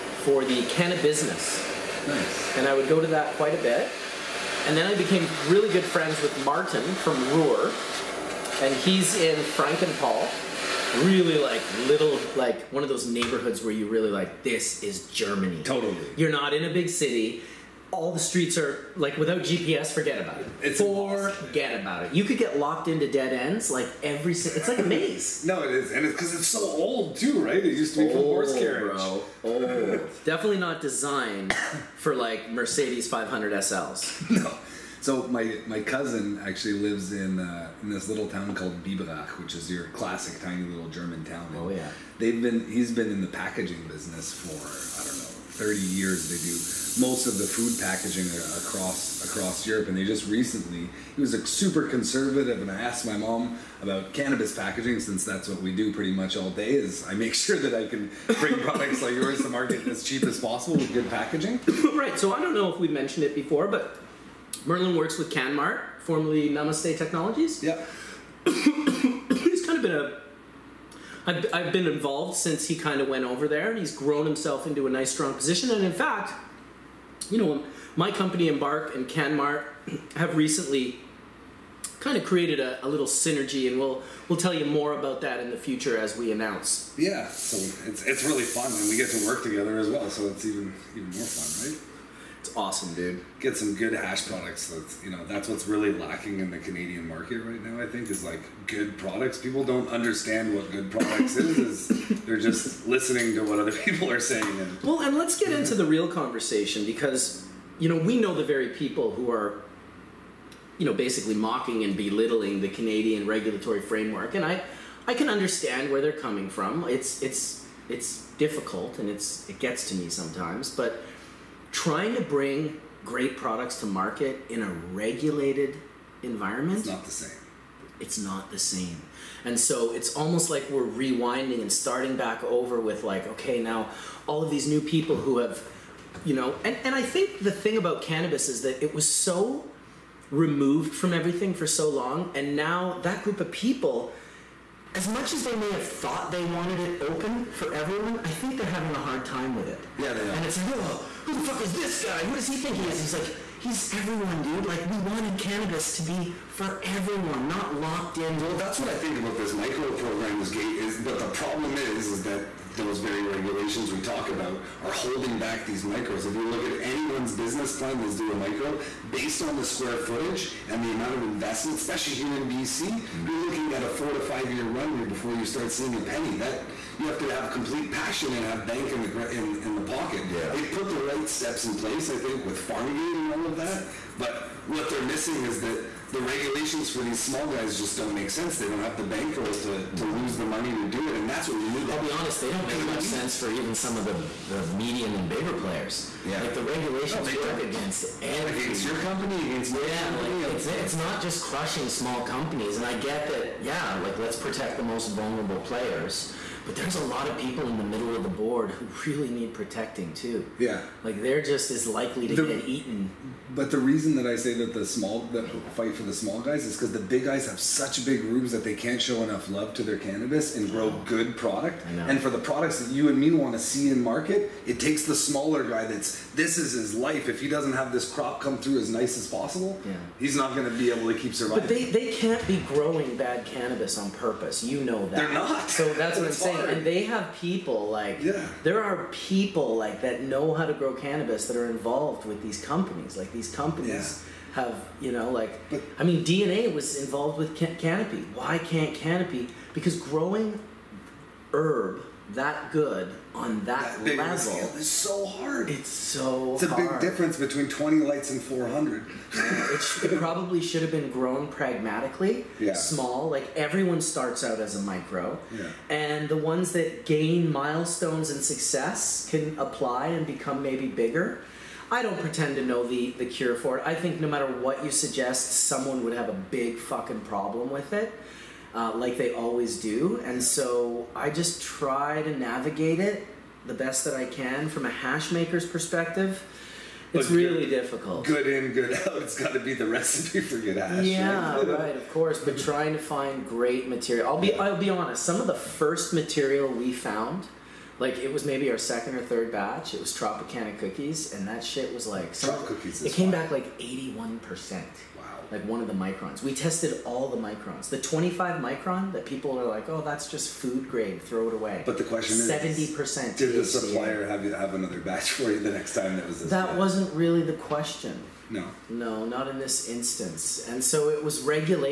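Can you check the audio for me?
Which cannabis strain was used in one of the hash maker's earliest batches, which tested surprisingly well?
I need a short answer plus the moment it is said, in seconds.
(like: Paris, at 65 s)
Tropicana Cookies, at 300 s.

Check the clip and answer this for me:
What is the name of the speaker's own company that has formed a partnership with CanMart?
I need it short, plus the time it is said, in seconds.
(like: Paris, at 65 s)
Embark, at 78 s.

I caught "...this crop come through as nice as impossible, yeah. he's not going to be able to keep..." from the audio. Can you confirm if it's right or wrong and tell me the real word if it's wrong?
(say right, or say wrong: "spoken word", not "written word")
wrong: "possible", not "impossible".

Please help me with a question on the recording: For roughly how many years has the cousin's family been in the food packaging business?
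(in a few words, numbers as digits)
30.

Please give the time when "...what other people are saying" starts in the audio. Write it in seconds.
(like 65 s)
103 s.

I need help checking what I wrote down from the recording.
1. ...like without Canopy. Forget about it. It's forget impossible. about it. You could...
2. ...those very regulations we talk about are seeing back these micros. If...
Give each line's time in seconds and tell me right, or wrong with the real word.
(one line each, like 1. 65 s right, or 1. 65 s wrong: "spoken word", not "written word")
1. 18 s wrong: "GPS", not "Canopy"
2. 162 s wrong: "holding", not "seeing".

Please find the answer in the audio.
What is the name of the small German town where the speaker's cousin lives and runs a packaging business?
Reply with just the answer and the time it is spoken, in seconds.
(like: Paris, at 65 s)
Biberach, at 38 s.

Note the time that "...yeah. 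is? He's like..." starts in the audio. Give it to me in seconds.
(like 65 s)
152 s.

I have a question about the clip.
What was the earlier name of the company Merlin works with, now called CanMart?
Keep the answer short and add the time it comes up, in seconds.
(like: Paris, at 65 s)
Namaste Technologies, at 66 s.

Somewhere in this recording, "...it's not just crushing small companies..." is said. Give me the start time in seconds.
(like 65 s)
200 s.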